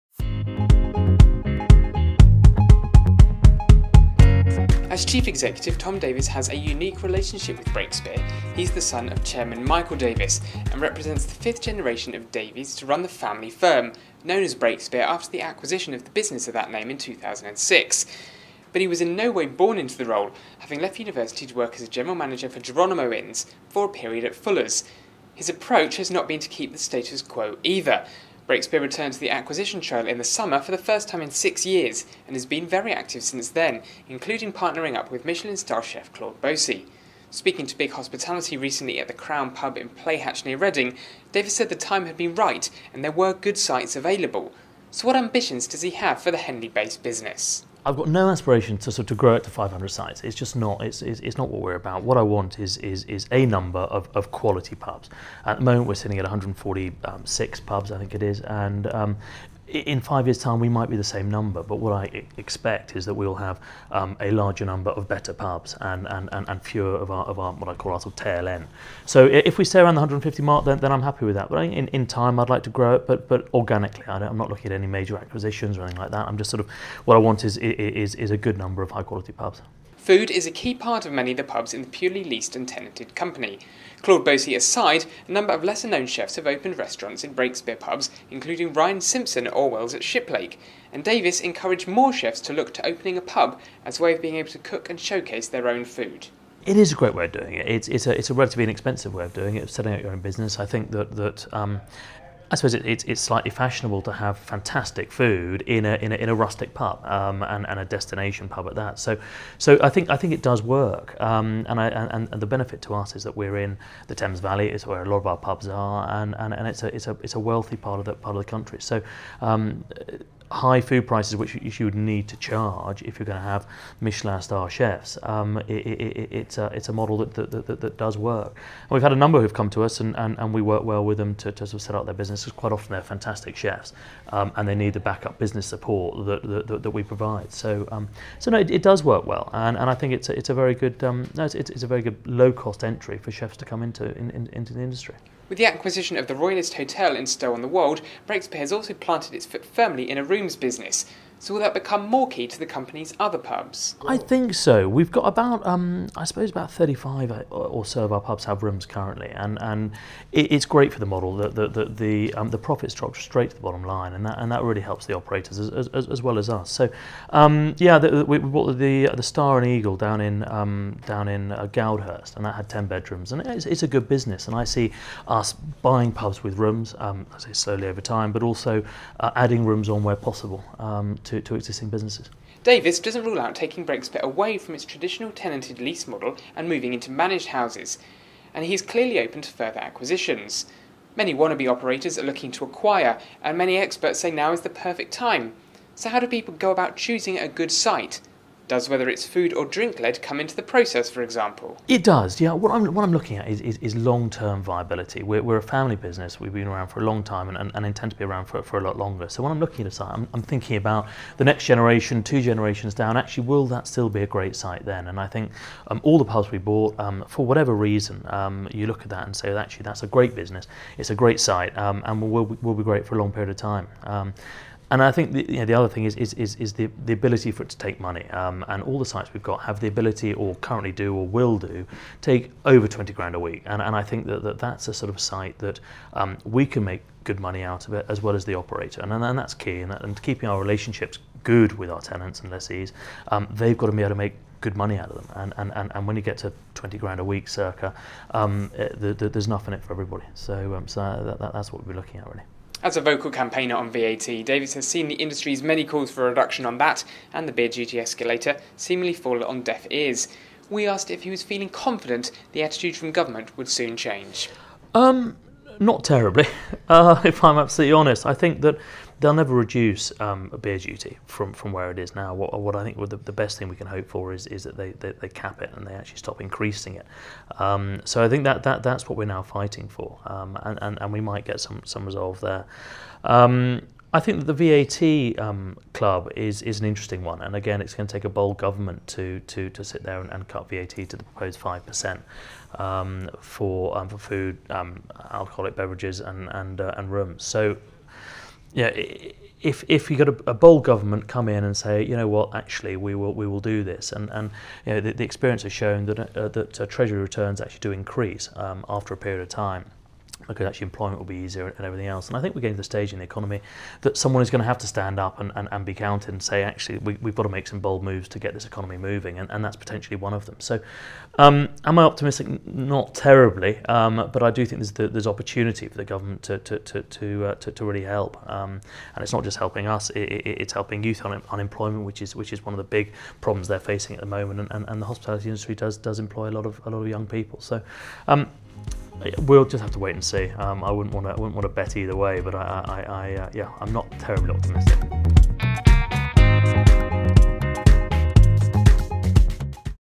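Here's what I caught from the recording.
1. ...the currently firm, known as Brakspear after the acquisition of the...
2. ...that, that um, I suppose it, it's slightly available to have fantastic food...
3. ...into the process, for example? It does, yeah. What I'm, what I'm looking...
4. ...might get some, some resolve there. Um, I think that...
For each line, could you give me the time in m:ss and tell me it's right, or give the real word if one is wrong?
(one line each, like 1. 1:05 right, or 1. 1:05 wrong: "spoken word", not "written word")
1. 0:13 wrong: "family", not "currently"
2. 1:40 wrong: "fashionable", not "available"
3. 3:20 right
4. 4:41 right.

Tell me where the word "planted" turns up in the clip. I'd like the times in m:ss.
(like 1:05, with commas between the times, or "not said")
2:28.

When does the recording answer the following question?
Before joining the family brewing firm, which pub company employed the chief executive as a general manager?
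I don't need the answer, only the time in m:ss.
0:22.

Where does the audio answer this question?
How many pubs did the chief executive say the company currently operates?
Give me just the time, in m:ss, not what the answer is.
0:56.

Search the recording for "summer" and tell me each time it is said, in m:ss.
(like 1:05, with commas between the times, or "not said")
0:30.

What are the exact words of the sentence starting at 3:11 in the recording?
Many wannabe operators are looking to acquire, and many experts say now is the perfect time.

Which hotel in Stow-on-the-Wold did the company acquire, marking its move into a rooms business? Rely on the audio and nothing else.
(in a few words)
Royalist Hotel.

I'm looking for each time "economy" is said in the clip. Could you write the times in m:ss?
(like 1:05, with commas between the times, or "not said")
5:13, 5:18.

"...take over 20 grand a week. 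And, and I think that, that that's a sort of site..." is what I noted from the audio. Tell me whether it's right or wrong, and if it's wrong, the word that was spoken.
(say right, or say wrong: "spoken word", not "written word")
right.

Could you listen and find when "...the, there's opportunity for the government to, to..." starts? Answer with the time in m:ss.
5:24.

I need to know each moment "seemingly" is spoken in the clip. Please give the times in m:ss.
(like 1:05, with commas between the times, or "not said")
4:18.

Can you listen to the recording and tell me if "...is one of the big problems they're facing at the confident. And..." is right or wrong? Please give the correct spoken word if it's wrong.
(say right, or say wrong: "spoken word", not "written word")
wrong: "moment", not "confident".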